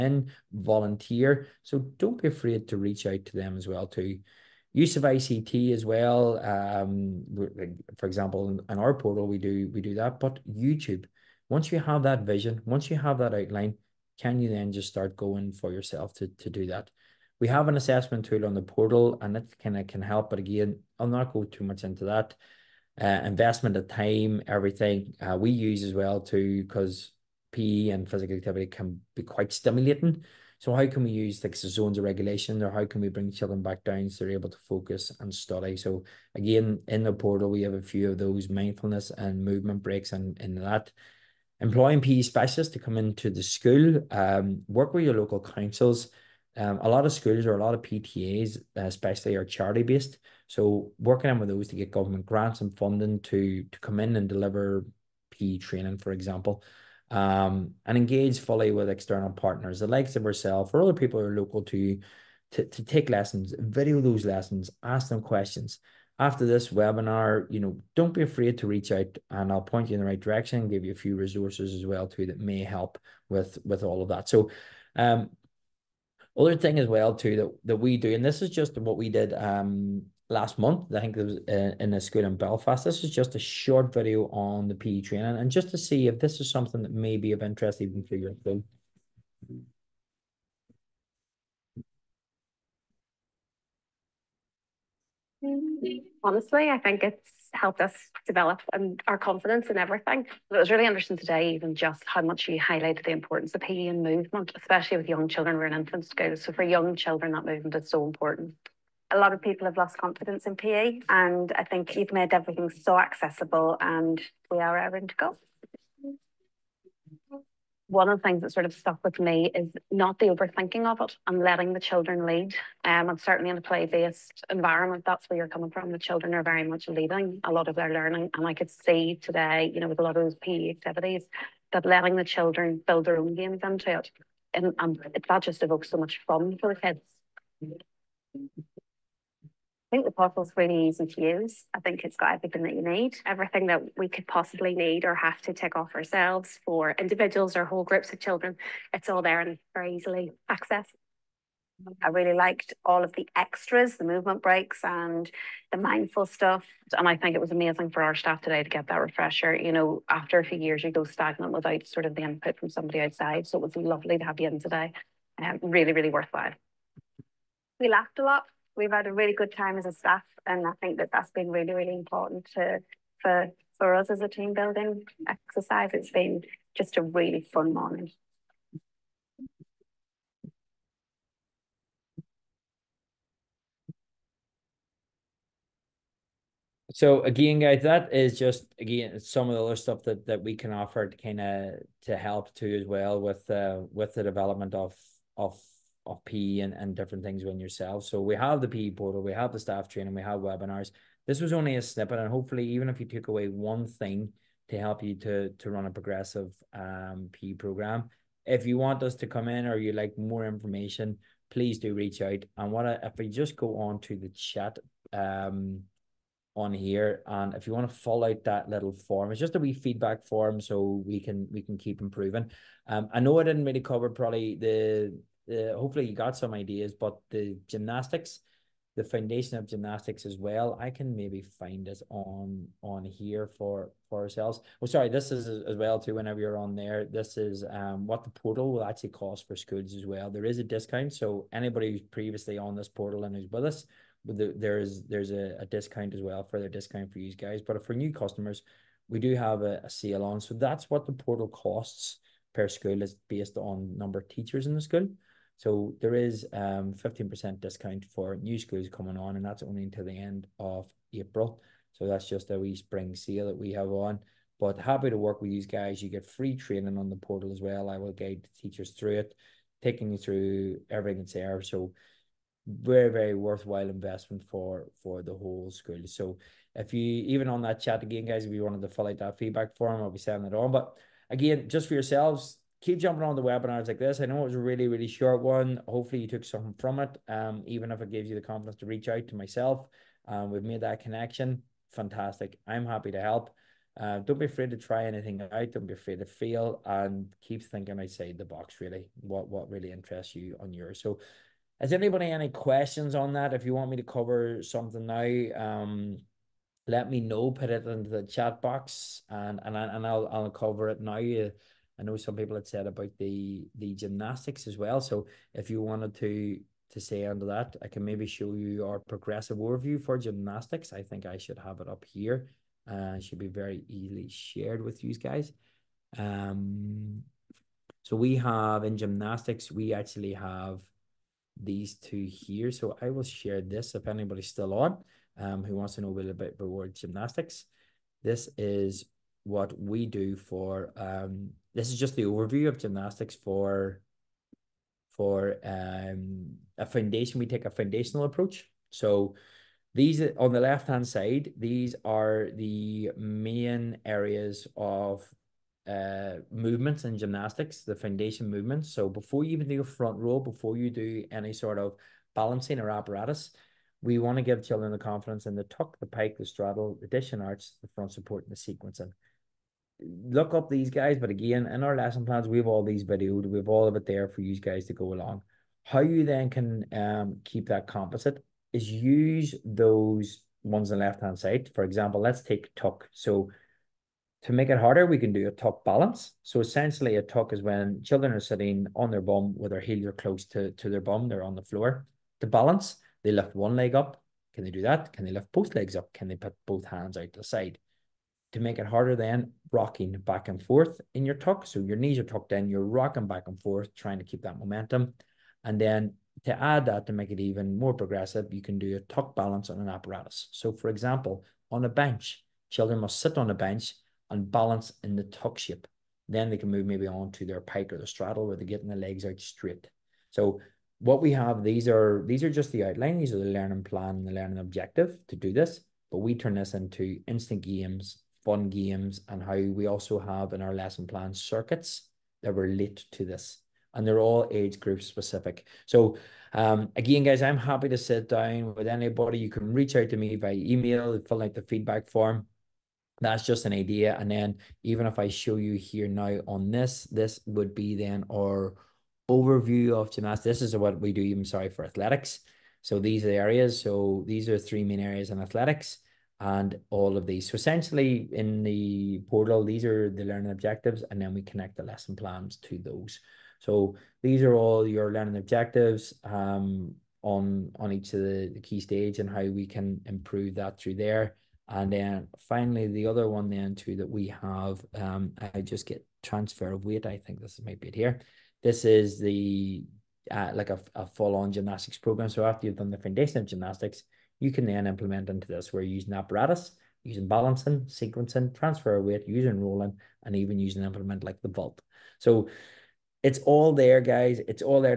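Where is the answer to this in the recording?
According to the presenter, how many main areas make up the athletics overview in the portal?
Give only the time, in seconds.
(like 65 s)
454 s.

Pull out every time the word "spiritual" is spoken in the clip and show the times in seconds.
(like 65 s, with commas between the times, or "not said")
not said.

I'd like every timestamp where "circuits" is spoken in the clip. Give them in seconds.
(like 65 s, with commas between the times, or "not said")
431 s.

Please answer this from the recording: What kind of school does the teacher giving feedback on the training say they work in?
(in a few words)
Infant school.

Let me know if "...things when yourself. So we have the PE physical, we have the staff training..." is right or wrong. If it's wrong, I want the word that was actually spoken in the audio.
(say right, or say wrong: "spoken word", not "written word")
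wrong: "portal", not "physical".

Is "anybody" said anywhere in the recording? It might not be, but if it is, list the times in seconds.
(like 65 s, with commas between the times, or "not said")
241 s, 301 s, 334 s, 438 s.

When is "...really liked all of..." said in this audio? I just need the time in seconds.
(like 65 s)
152 s.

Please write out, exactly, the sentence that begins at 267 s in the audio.
I will guide the teachers through it, taking you through everything that's there.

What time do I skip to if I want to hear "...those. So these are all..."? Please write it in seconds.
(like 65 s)
462 s.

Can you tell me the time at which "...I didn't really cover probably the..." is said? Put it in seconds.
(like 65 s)
223 s.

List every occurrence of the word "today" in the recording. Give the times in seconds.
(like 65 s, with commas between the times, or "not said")
101 s, 129 s, 158 s, 164 s.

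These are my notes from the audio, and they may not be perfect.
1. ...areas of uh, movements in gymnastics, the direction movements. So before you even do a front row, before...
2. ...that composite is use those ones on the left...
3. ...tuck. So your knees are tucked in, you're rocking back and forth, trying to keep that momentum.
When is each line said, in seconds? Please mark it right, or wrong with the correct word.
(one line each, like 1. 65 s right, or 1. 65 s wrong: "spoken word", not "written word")
1. 354 s wrong: "foundation", not "direction"
2. 377 s right
3. 401 s right.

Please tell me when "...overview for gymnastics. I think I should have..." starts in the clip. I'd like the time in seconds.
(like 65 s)
319 s.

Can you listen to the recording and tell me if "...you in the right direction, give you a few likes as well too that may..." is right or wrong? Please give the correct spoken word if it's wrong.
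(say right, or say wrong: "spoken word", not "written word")
wrong: "resources", not "likes".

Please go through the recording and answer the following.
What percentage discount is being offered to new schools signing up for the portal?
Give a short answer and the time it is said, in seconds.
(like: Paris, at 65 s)
15%, at 256 s.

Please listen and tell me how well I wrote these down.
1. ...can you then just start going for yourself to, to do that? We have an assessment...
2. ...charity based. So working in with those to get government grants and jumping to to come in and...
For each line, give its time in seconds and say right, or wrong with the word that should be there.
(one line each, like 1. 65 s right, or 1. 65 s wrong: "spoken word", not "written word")
1. 14 s right
2. 49 s wrong: "funding", not "jumping".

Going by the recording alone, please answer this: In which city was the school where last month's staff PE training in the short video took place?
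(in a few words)
Belfast.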